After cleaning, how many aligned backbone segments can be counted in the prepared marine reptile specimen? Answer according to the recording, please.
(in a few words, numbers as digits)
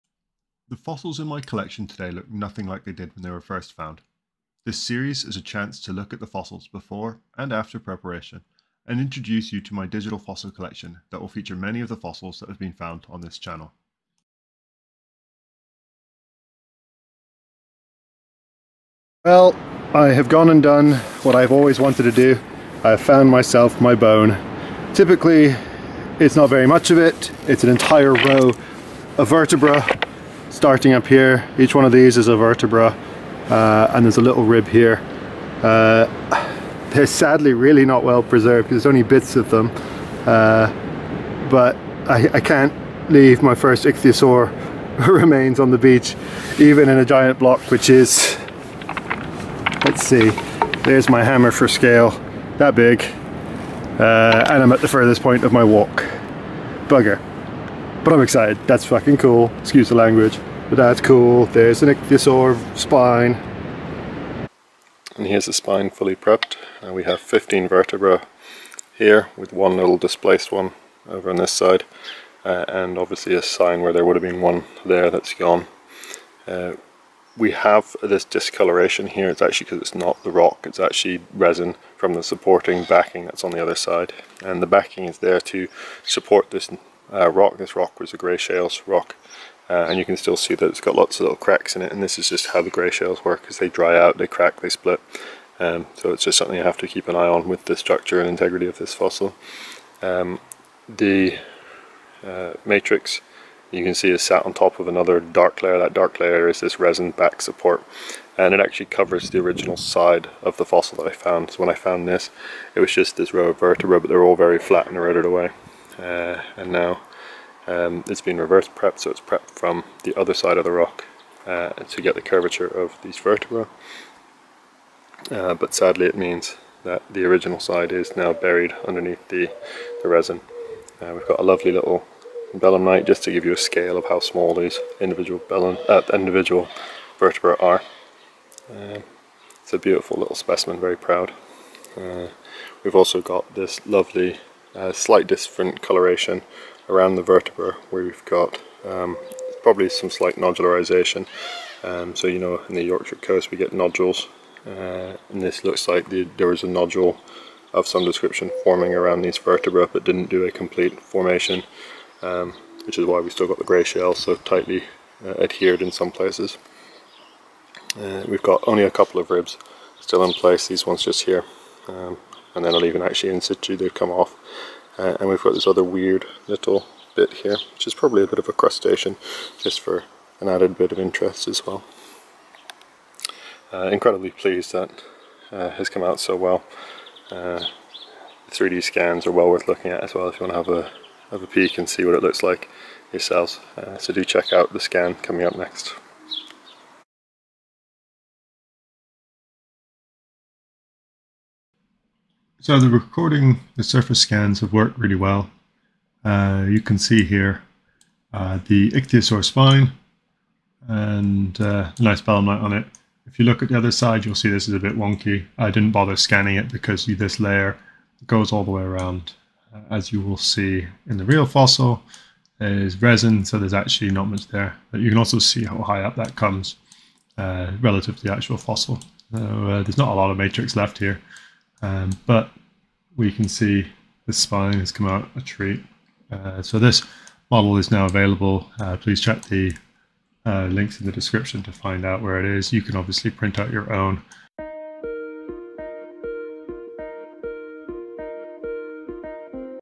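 15.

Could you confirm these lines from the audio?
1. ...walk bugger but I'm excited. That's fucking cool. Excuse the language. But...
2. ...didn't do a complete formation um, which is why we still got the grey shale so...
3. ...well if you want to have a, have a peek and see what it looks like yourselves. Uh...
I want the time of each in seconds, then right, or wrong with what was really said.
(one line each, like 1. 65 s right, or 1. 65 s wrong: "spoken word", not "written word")
1. 55 s right
2. 160 s right
3. 190 s right.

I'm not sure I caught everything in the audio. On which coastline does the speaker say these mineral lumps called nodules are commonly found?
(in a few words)
Yorkshire coast.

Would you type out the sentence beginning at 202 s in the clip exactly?
So the recording, the surface scans have worked really well.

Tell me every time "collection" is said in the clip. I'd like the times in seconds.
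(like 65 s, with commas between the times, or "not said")
1 s, 10 s.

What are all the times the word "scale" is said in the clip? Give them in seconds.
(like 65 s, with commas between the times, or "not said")
51 s, 133 s.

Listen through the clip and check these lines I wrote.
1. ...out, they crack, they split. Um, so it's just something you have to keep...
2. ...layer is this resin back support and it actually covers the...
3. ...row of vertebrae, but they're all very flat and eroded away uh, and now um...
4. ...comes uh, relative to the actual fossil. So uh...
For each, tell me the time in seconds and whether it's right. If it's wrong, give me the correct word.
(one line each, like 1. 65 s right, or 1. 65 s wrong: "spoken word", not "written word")
1. 93 s right
2. 106 s right
3. 113 s right
4. 226 s right.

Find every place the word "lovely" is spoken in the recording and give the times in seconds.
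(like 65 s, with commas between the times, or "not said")
131 s, 143 s.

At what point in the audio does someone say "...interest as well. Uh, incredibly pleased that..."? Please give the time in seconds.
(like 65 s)
180 s.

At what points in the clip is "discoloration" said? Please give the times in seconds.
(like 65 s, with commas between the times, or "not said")
78 s.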